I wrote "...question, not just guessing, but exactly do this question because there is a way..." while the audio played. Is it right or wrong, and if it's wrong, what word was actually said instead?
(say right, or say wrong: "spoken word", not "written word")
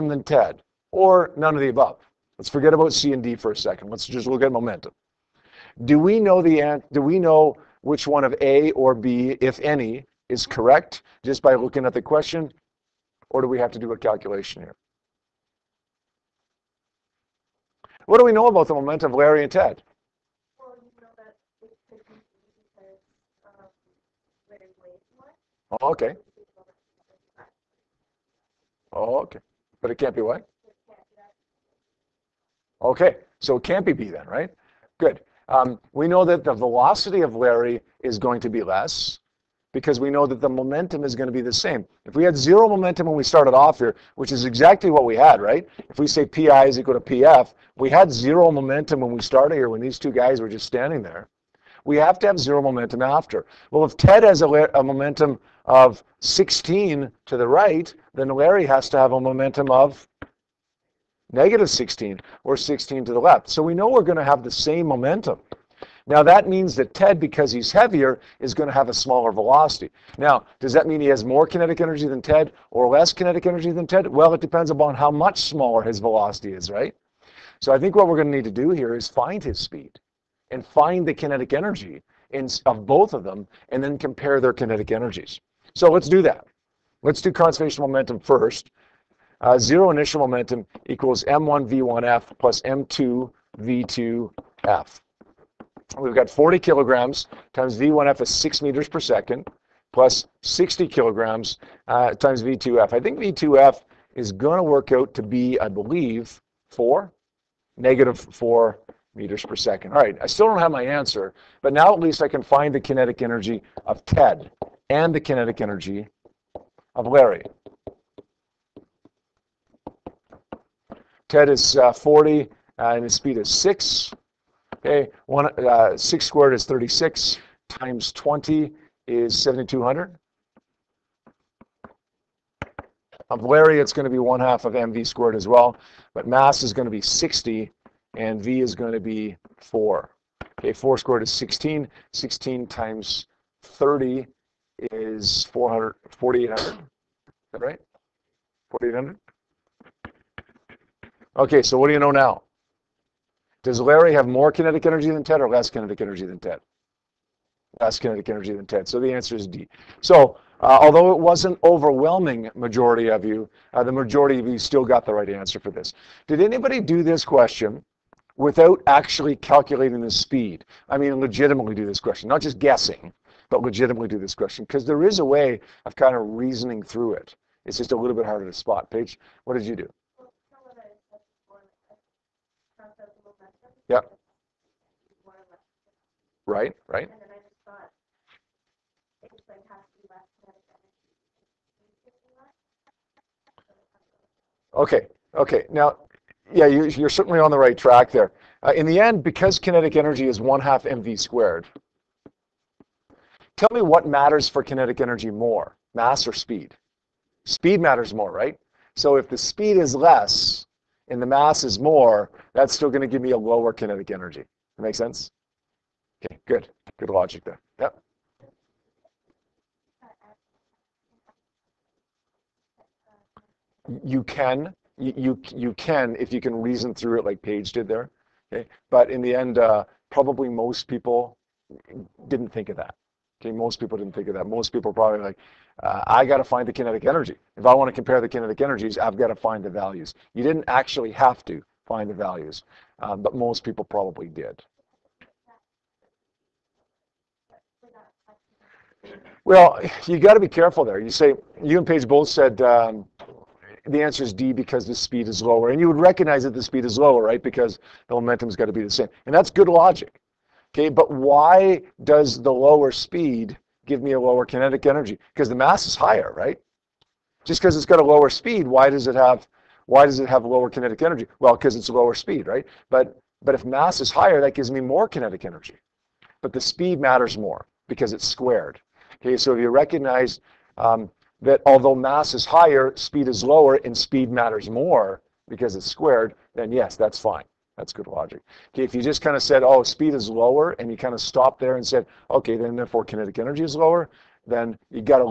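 wrong: "legitimately", not "exactly".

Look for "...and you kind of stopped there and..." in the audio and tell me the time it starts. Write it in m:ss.
4:50.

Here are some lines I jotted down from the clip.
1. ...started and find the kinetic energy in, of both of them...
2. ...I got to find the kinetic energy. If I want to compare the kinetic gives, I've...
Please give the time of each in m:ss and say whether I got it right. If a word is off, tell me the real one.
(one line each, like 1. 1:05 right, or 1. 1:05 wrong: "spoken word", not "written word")
1. 1:19 wrong: "speed", not "started"
2. 3:56 wrong: "energies", not "gives".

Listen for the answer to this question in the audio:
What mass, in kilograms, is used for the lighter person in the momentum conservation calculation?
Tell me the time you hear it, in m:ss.
1:36.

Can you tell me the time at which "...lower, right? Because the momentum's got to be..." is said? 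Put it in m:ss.
4:16.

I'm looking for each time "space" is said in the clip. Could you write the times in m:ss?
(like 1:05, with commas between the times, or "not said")
not said.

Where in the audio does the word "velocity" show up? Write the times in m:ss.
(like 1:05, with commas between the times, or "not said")
0:36, 1:09, 1:15.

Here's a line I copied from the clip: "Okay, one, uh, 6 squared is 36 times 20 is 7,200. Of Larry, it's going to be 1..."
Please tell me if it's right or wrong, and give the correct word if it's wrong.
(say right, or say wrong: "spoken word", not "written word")
right.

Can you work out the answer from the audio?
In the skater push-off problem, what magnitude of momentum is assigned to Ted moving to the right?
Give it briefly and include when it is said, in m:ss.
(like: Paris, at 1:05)
16, at 0:54.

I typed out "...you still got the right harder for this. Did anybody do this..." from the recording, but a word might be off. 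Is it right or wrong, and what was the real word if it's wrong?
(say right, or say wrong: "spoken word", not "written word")
wrong: "answer", not "harder".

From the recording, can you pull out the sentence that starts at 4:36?
But the speed matters more because it's squared.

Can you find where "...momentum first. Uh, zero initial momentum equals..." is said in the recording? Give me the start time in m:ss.
1:27.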